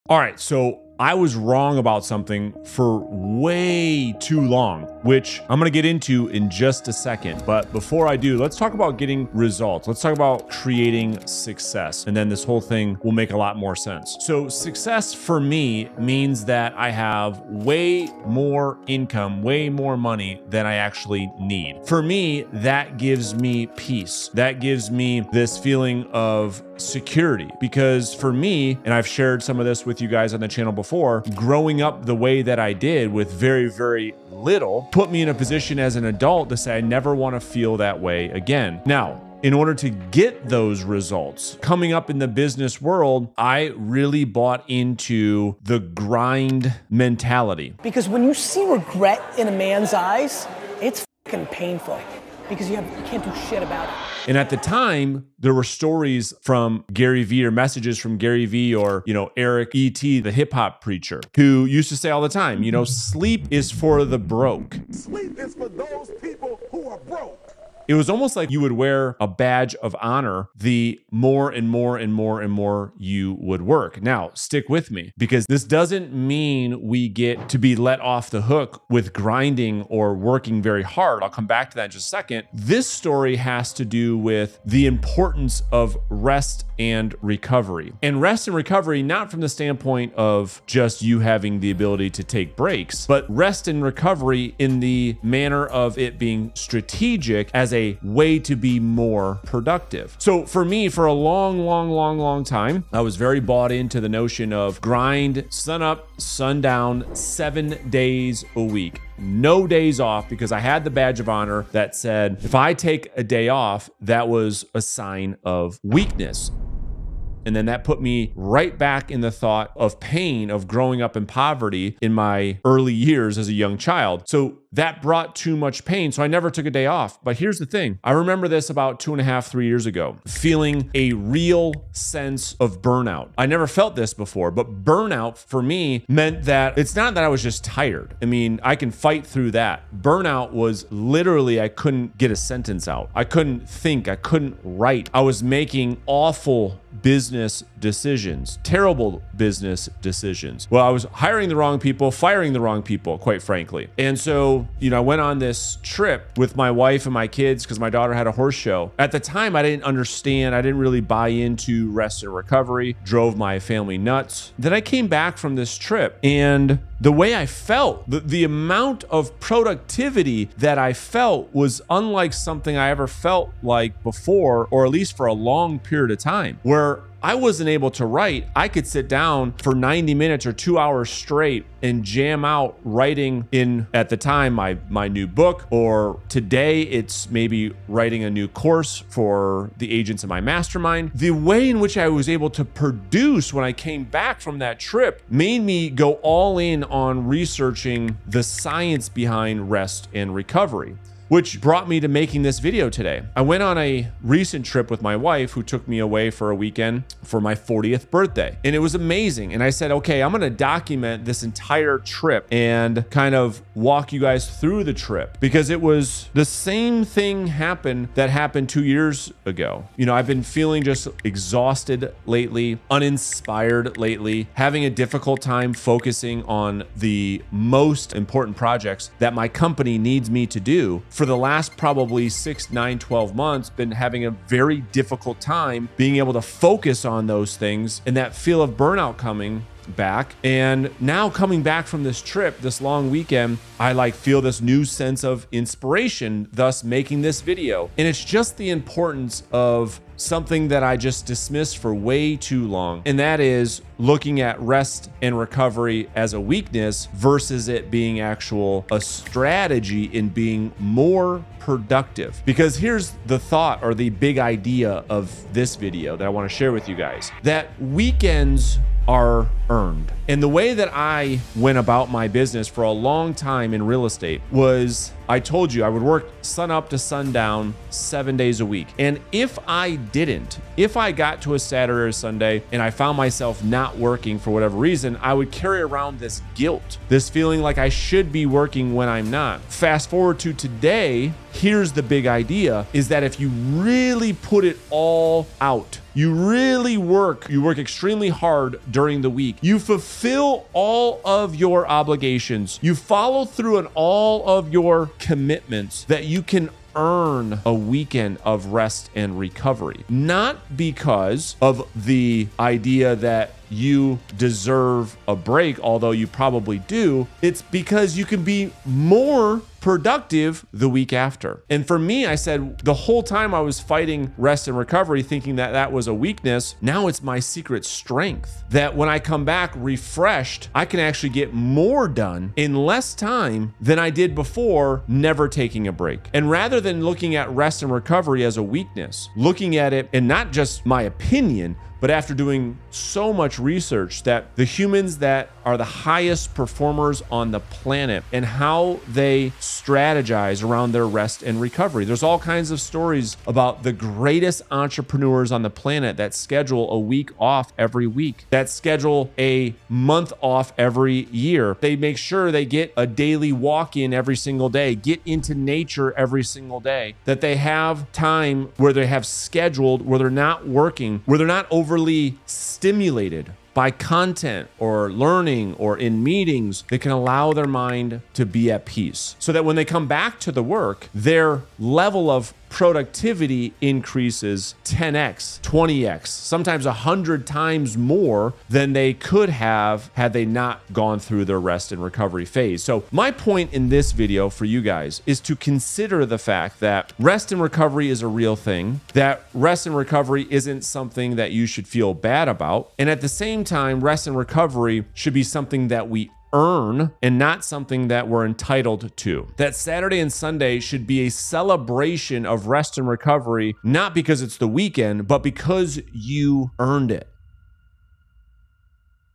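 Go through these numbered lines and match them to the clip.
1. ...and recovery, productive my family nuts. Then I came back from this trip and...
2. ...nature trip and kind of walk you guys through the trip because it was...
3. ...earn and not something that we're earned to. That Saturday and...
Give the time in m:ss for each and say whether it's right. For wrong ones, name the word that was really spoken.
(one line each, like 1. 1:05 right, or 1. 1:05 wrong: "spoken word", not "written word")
1. 2:42 wrong: "drove", not "productive"
2. 3:31 wrong: "entire", not "nature"
3. 6:46 wrong: "entitled", not "earned".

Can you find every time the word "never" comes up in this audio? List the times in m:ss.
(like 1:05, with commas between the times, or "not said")
0:36, 2:06, 2:13, 5:35.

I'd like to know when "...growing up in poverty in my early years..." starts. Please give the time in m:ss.
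2:00.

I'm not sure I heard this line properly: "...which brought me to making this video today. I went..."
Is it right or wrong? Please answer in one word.
right.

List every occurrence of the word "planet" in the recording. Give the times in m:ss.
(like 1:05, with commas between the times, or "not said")
5:47, 5:55.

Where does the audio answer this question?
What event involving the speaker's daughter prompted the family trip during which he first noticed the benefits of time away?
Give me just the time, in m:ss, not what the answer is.
2:38.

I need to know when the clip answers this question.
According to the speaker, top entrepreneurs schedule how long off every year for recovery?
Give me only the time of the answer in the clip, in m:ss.
5:59.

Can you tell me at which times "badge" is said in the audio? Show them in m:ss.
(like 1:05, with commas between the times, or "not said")
1:09, 1:50.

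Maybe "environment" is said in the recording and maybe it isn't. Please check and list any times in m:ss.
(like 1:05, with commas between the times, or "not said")
not said.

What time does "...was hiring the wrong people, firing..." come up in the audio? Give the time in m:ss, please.
2:30.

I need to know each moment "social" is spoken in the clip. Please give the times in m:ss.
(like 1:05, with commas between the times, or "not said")
not said.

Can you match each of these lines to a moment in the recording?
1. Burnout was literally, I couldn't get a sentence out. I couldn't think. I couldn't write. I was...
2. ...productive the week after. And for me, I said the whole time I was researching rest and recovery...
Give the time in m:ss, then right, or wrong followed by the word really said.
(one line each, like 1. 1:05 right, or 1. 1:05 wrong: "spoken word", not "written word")
1. 2:20 right
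2. 5:19 wrong: "fighting", not "researching".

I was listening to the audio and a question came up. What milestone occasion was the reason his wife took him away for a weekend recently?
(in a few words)
40th birthday.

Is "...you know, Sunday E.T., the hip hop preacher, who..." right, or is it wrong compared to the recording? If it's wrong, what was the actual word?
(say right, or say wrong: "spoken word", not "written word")
wrong: "Eric", not "Sunday".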